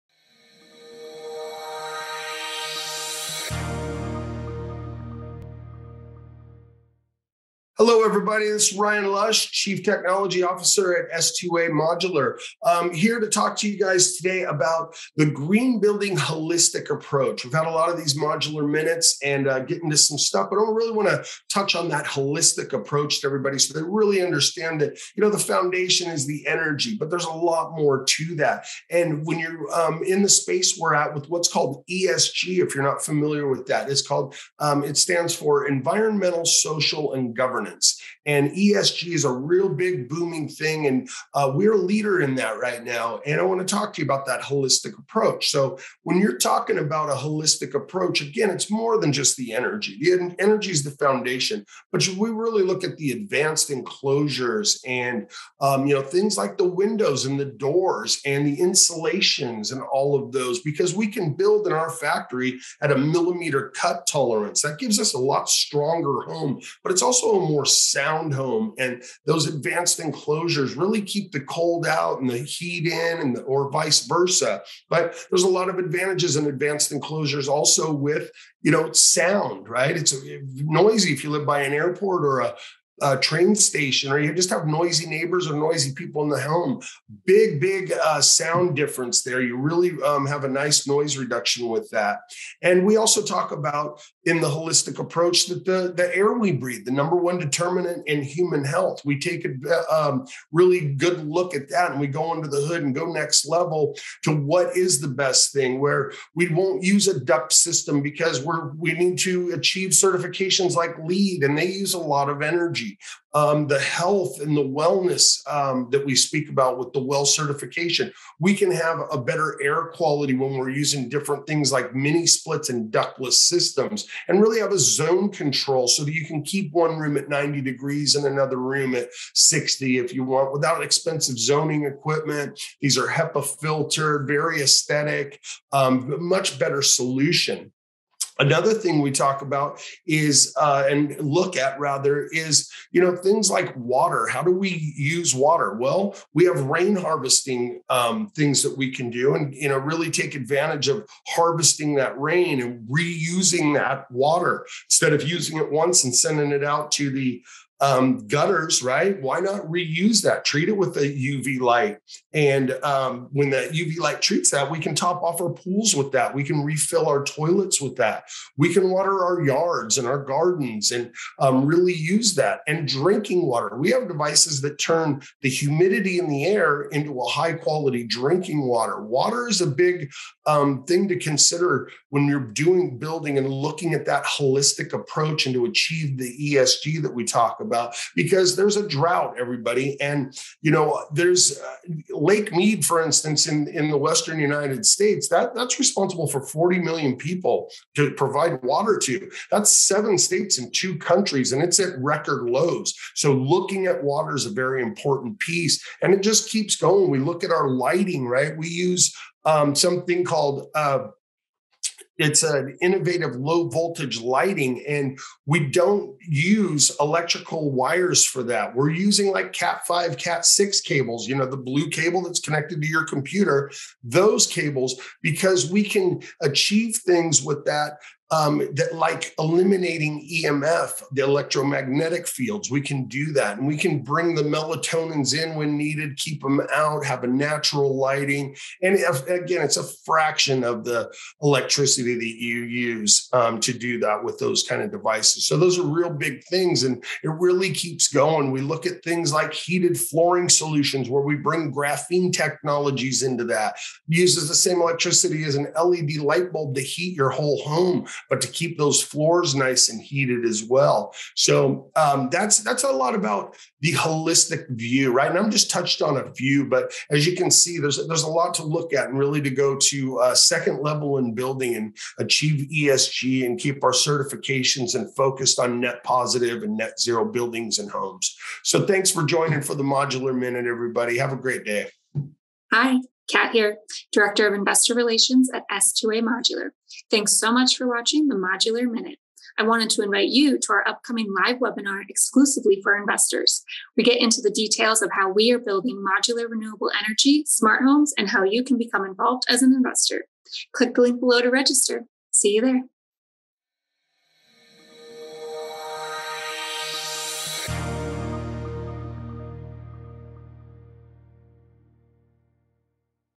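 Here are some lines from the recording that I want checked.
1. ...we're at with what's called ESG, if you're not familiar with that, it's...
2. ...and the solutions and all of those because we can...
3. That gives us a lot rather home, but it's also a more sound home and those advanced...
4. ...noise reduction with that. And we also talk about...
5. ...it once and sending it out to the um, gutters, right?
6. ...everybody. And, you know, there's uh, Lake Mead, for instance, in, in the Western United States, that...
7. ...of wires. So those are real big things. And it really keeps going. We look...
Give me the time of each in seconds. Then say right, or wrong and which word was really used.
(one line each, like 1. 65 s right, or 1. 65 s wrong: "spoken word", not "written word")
1. 30 s right
2. 58 s wrong: "insulations", not "solutions"
3. 64 s wrong: "stronger", not "rather"
4. 90 s right
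5. 155 s right
6. 189 s right
7. 244 s wrong: "devices", not "wires".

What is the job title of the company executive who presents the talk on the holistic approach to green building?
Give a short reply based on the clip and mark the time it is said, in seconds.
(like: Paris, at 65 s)
Chief Technology Officer, at 9 s.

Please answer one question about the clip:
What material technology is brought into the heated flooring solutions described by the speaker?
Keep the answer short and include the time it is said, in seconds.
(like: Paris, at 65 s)
graphene, at 251 s.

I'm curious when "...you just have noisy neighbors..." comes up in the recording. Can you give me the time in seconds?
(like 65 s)
84 s.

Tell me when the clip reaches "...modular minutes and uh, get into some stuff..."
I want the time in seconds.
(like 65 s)
18 s.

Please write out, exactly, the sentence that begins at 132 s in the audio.
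These are HEPA filtered, very aesthetic, um, much better solution.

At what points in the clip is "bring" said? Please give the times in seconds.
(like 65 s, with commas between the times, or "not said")
234 s, 251 s.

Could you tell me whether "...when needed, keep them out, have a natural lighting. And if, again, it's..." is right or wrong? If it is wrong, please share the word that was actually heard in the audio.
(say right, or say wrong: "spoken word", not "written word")
right.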